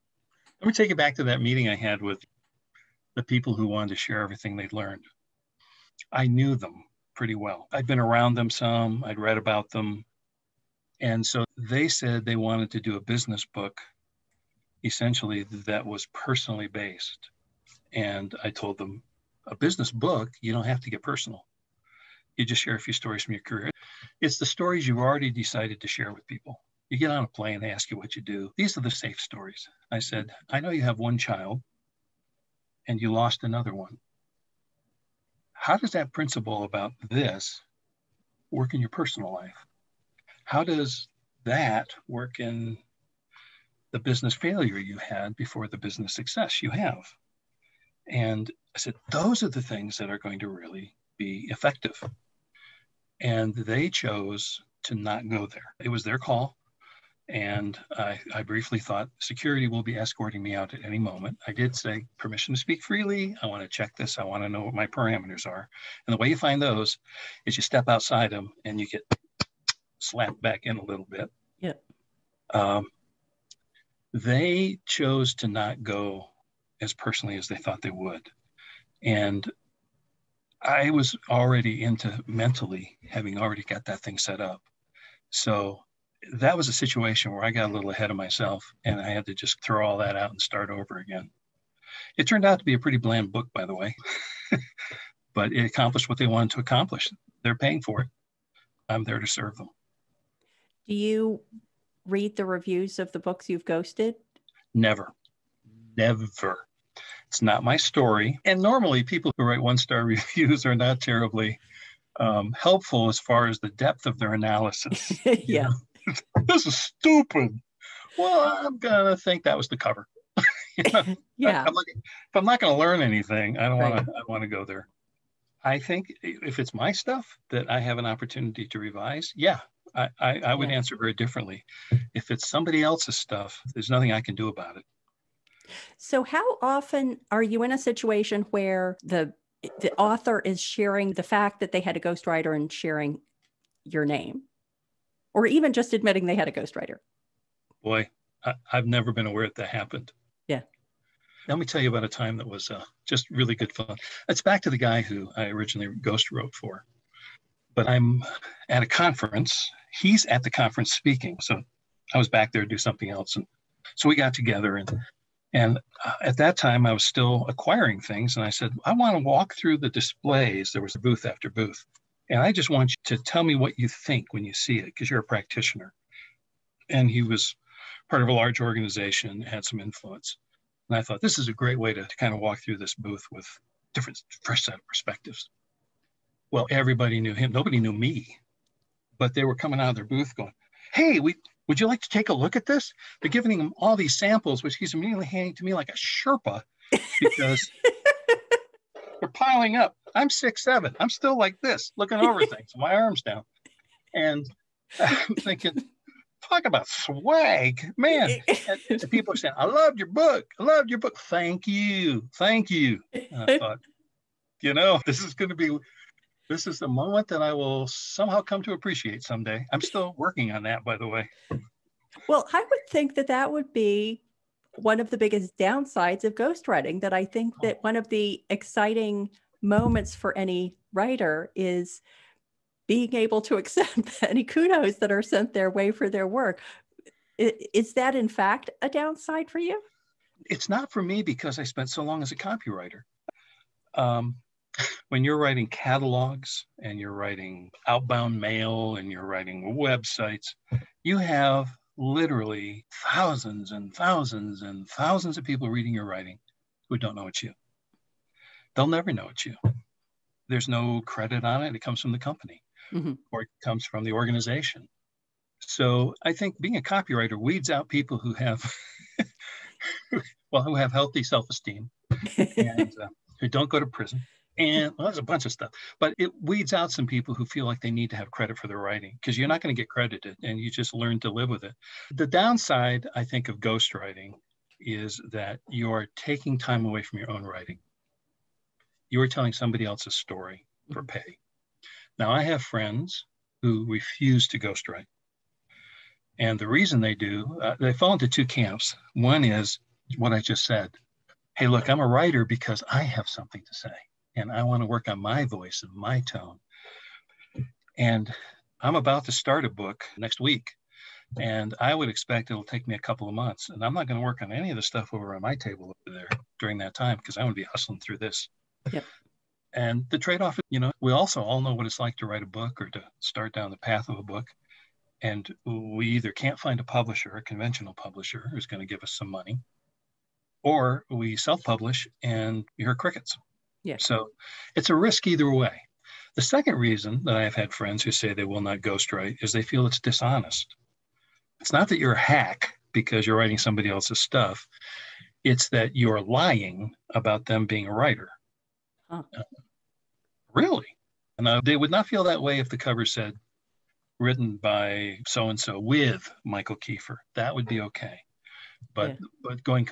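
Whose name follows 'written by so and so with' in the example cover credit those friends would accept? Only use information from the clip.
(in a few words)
Mikal Keefer.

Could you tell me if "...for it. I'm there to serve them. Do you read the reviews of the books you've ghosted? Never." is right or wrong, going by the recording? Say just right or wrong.
right.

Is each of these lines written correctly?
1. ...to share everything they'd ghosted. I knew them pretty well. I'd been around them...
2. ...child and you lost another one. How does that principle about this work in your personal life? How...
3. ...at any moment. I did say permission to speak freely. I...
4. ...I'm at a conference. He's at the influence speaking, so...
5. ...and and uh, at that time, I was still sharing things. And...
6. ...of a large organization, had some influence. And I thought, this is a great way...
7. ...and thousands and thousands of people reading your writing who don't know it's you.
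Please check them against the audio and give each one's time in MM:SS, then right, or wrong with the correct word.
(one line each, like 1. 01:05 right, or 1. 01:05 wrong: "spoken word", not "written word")
1. 00:03 wrong: "learned", not "ghosted"
2. 00:31 right
3. 01:00 right
4. 02:37 wrong: "conference", not "influence"
5. 02:44 wrong: "acquiring", not "sharing"
6. 02:58 right
7. 04:13 right.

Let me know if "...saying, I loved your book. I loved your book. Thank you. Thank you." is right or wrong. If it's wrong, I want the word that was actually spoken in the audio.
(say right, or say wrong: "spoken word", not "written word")
right.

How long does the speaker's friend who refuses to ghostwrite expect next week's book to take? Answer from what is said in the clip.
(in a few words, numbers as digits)
a couple of months.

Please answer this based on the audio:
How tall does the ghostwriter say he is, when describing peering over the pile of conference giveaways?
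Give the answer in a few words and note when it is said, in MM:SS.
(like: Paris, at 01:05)
6'7", at 03:20.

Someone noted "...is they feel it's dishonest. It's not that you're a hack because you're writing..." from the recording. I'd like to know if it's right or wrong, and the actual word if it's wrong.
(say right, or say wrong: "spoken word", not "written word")
right.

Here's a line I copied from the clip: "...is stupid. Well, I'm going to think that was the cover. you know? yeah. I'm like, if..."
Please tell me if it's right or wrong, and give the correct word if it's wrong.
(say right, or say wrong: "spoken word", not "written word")
right.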